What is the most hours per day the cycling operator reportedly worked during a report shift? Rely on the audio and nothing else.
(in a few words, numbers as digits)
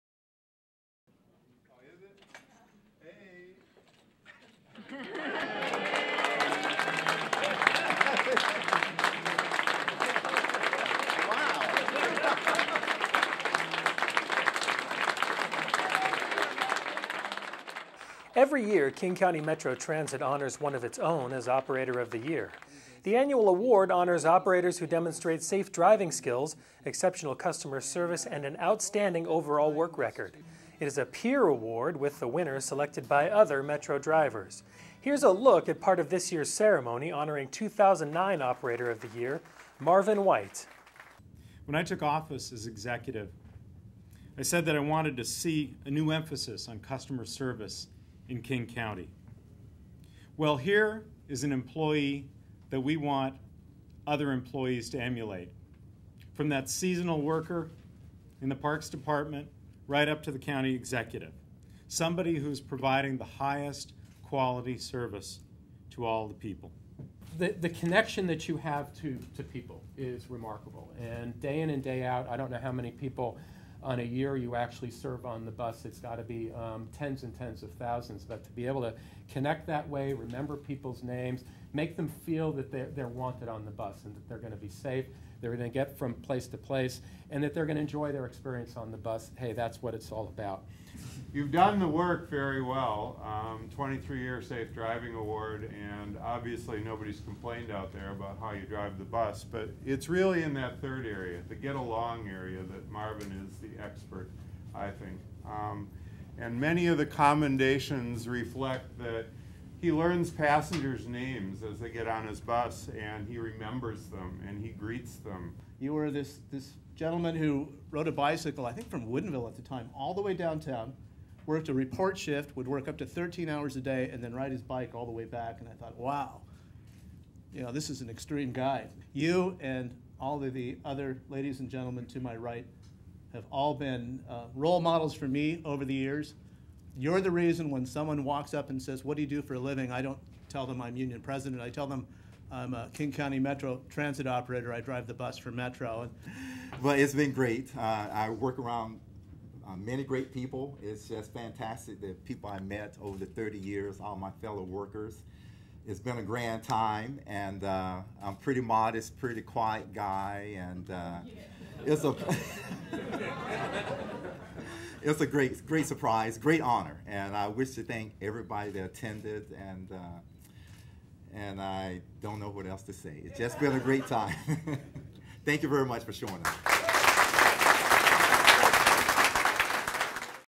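13.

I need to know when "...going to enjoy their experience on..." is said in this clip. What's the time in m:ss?
1:27.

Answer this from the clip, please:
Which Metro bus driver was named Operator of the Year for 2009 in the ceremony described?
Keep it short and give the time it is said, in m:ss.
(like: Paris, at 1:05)
Marvin White, at 0:39.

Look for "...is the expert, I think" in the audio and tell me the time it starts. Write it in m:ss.
1:43.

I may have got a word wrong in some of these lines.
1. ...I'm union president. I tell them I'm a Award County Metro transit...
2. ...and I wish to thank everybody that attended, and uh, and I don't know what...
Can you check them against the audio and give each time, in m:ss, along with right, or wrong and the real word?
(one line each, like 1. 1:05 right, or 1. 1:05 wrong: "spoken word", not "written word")
1. 2:20 wrong: "King", not "Award"
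2. 2:47 right.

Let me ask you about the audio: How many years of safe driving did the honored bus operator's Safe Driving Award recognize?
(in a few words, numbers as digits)
23.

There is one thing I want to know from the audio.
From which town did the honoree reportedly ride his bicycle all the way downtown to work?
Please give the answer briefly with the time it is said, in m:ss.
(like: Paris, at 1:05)
Woodinville, at 1:59.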